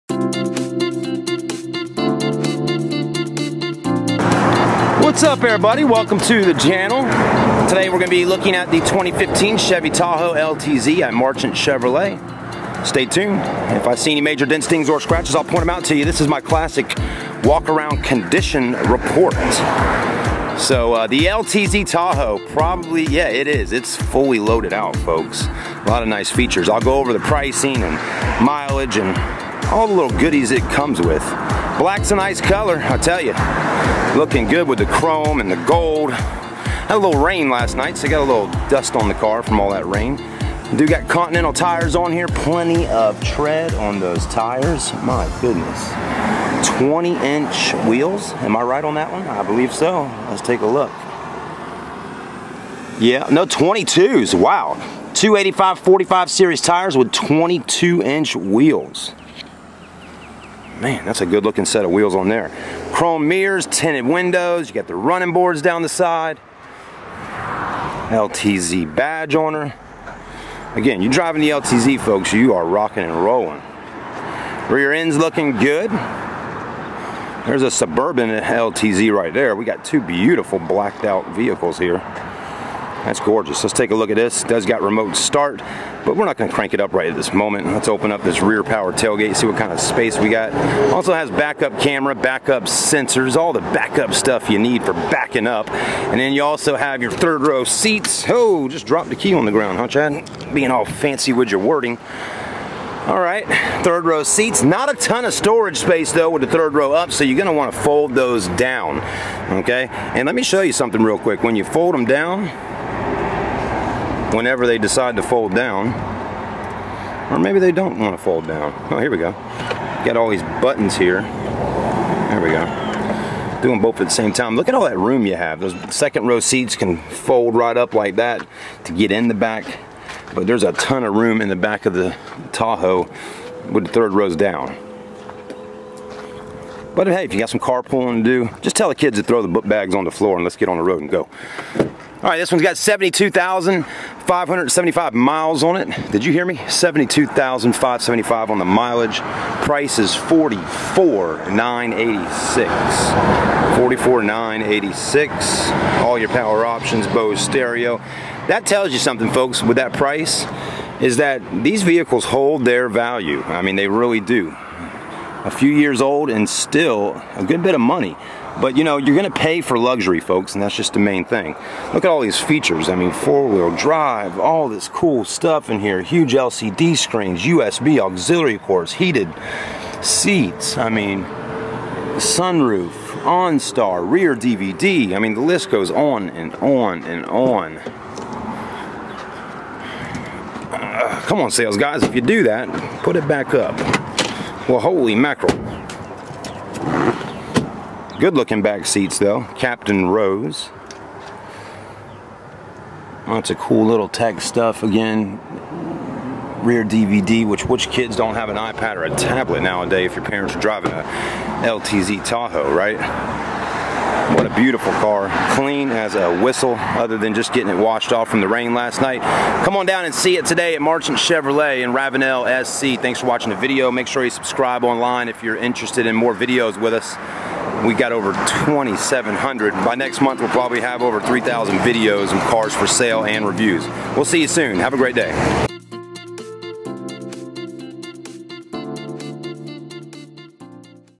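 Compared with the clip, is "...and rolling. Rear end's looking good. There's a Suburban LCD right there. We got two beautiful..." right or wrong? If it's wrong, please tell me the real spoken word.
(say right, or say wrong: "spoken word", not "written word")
wrong: "LTZ", not "LCD".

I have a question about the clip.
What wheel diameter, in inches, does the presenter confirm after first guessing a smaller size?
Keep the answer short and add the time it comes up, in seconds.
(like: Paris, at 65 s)
22, at 53 s.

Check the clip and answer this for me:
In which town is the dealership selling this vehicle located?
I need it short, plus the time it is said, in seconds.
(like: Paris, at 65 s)
Ravenel SC, at 221 s.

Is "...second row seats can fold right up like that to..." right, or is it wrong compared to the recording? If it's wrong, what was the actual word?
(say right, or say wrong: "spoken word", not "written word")
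right.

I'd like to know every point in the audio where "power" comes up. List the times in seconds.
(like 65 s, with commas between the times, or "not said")
88 s, 156 s.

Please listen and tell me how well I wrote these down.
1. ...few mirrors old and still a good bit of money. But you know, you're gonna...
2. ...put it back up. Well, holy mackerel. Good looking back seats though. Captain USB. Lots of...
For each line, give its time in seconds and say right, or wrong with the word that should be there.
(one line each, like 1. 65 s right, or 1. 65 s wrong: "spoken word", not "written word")
1. 165 s wrong: "years", not "mirrors"
2. 193 s wrong: "Rose", not "USB".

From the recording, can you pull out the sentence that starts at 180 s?
I mean, sunroof, OnStar, rear DVD.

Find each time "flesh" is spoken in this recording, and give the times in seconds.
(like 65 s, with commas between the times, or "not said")
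not said.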